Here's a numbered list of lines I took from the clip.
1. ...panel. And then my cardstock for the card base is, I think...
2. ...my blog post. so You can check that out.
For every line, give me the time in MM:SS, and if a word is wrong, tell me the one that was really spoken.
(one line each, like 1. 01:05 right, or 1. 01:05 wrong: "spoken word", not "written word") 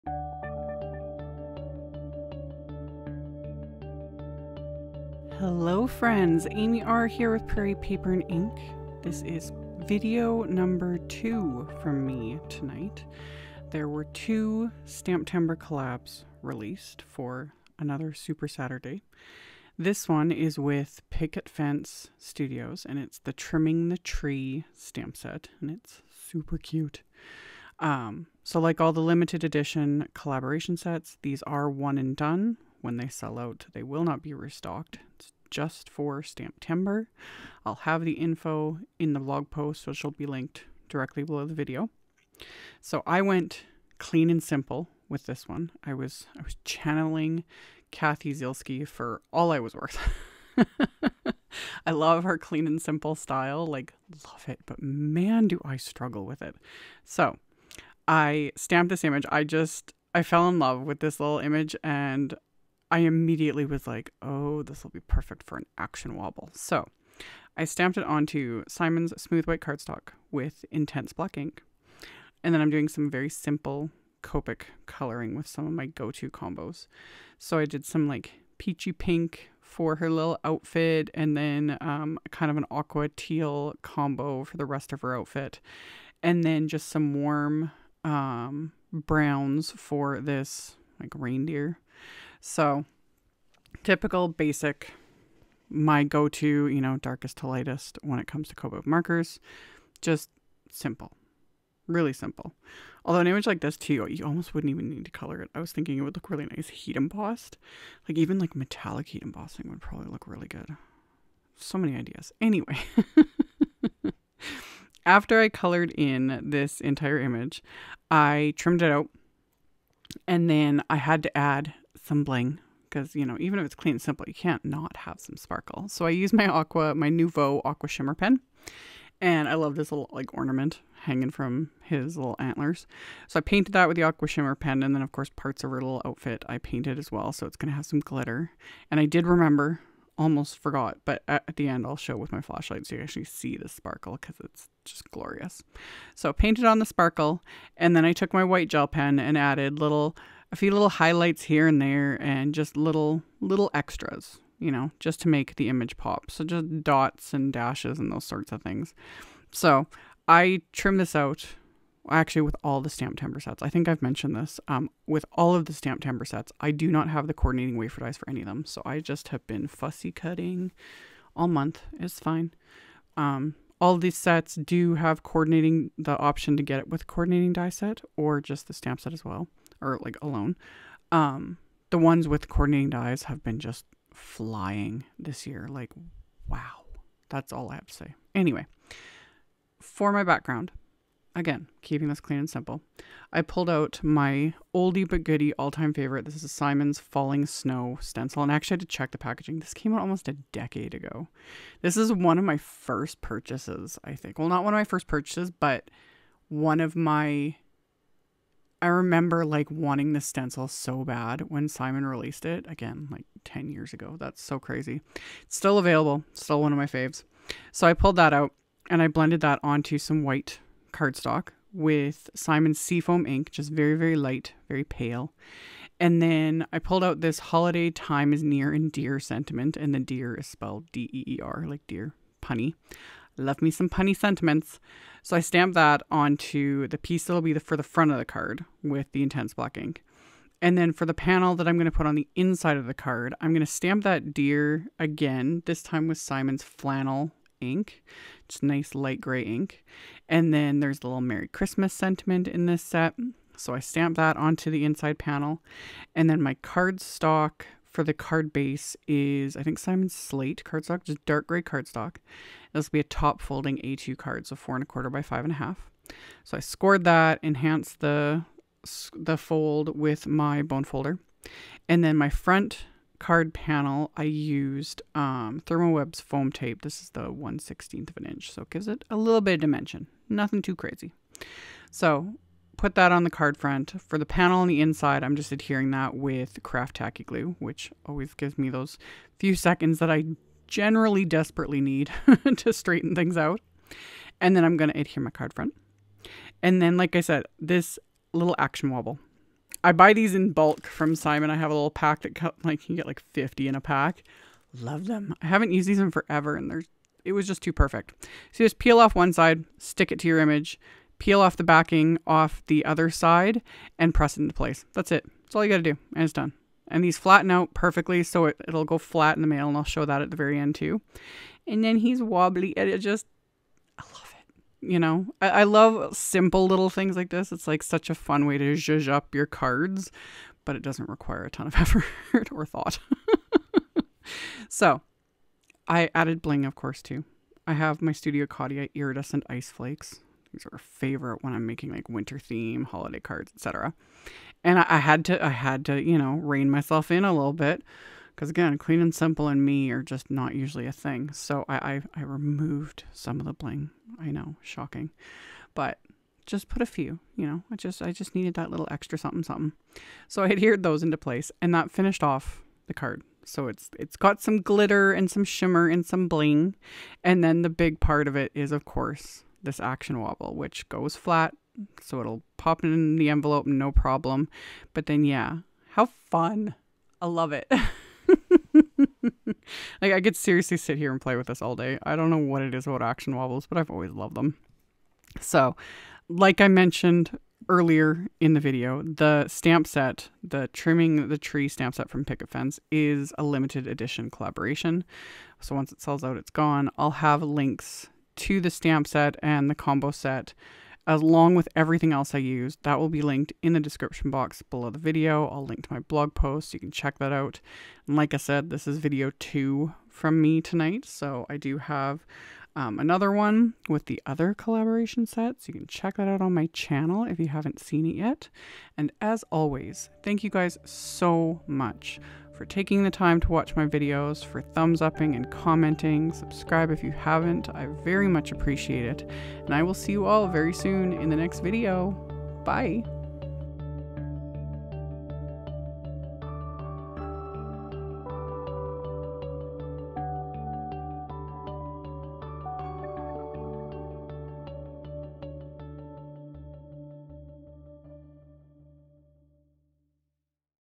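1. 04:15 right
2. 06:45 right.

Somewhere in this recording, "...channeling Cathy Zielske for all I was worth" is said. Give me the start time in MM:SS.
00:46.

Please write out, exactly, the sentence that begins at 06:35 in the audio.
So once it sells out, it's gone.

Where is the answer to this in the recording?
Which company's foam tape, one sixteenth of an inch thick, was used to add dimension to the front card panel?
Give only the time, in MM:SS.
04:35.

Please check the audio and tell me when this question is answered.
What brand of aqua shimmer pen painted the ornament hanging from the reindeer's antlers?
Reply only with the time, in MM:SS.
02:07.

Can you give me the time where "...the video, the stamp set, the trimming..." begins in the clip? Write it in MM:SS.
06:28.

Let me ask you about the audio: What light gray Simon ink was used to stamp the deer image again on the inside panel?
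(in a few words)
Flannel.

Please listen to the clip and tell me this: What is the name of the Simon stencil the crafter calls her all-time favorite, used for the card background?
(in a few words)
Falling Snow.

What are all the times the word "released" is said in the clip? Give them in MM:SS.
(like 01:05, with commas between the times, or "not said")
00:16, 03:32.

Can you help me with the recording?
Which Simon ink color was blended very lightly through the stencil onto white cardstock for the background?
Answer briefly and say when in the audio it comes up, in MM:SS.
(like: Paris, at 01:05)
Seafoam, at 03:42.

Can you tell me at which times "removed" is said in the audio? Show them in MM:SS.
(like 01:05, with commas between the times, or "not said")
05:52.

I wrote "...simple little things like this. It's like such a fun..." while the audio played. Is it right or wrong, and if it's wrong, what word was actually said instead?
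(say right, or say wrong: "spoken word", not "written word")
right.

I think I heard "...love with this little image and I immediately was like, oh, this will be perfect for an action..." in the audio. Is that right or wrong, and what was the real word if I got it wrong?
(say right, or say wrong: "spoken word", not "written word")
right.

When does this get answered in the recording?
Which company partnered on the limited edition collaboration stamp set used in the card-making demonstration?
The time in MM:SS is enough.
00:21.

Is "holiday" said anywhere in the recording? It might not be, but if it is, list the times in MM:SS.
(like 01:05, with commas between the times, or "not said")
03:47, 05:42.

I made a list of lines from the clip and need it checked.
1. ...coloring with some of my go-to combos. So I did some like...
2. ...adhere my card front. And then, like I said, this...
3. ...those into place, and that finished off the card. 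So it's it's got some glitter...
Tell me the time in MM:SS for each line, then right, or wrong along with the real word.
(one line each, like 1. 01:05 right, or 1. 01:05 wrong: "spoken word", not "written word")
1. 01:14 right
2. 04:54 right
3. 06:00 right.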